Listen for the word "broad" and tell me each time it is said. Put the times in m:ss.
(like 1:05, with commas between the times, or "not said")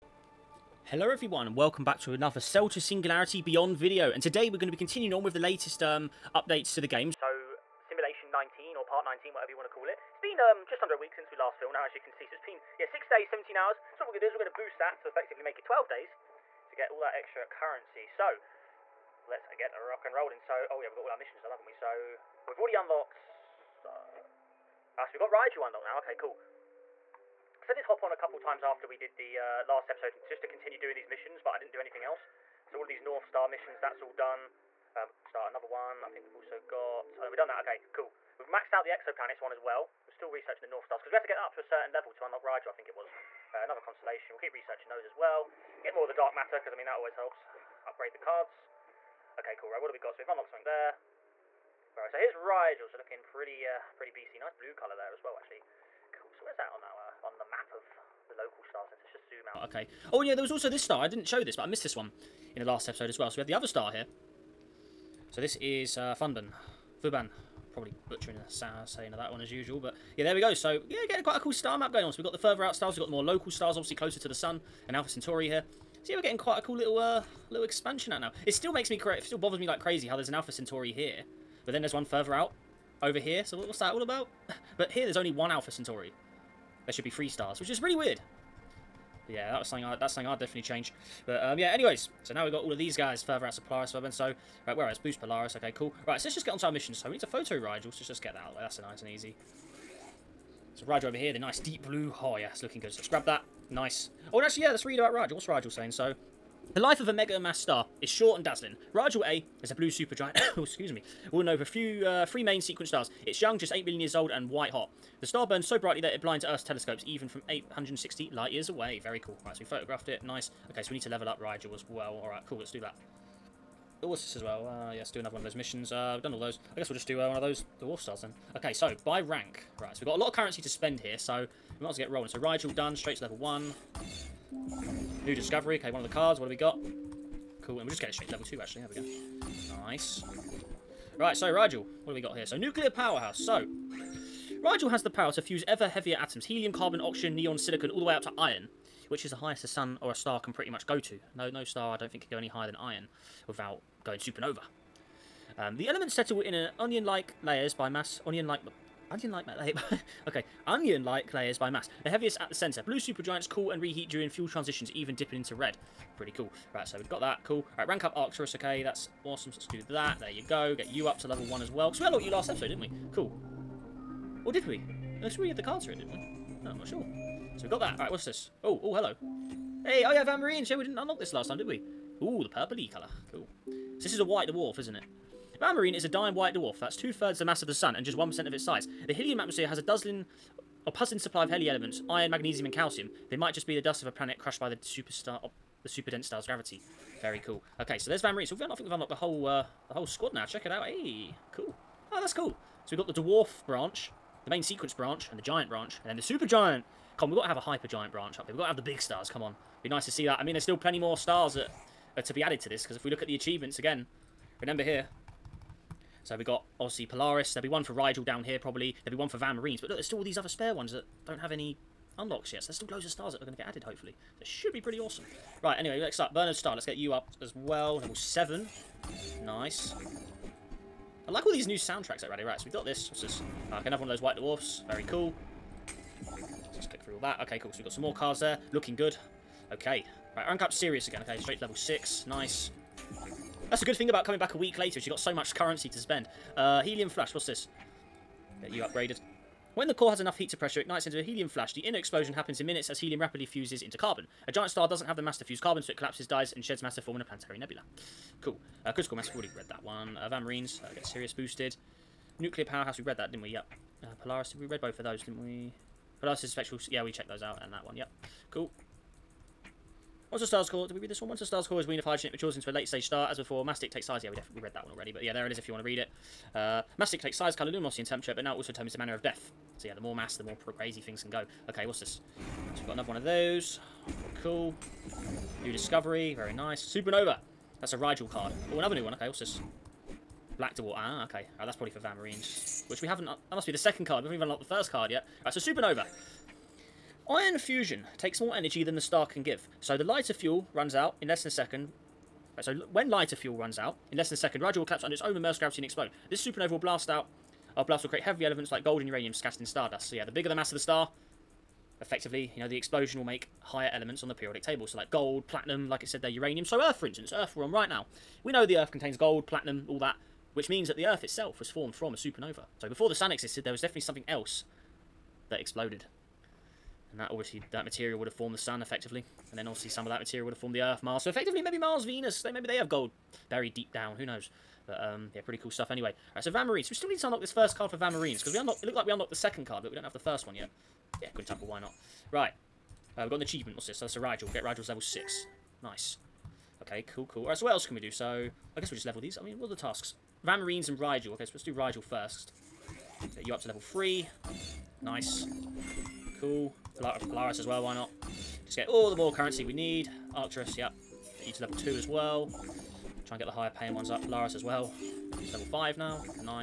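not said.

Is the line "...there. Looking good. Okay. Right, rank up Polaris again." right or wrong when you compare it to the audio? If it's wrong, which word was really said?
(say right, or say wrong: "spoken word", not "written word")
wrong: "Sirius", not "Polaris".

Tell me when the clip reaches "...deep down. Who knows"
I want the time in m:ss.
5:33.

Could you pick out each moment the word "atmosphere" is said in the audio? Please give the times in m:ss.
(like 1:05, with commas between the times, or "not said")
3:09.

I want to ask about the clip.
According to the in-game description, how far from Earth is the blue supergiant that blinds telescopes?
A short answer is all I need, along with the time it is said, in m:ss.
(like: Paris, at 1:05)
860 light years, at 1:57.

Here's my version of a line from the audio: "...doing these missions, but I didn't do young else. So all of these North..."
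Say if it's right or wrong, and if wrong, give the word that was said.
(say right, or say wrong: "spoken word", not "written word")
wrong: "anything", not "young".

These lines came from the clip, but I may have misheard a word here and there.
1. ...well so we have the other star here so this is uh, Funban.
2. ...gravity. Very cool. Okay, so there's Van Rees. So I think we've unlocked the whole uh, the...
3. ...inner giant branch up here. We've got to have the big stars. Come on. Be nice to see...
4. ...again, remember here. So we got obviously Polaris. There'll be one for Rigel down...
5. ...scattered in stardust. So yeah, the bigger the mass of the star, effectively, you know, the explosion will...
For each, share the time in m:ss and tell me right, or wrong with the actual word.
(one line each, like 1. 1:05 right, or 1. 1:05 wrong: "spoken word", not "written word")
1. 1:03 right
2. 3:16 right
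3. 3:27 wrong: "hyper", not "inner"
4. 3:33 right
5. 5:09 right.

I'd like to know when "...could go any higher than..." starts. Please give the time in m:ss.
2:32.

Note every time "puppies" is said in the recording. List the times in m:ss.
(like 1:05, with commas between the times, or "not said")
not said.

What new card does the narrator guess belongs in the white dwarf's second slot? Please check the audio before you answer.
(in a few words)
Black Dwarf.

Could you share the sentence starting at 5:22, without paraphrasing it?
So before the Sun existed, there was definitely something else that exploded.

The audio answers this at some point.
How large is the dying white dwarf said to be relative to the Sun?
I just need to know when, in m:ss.
3:08.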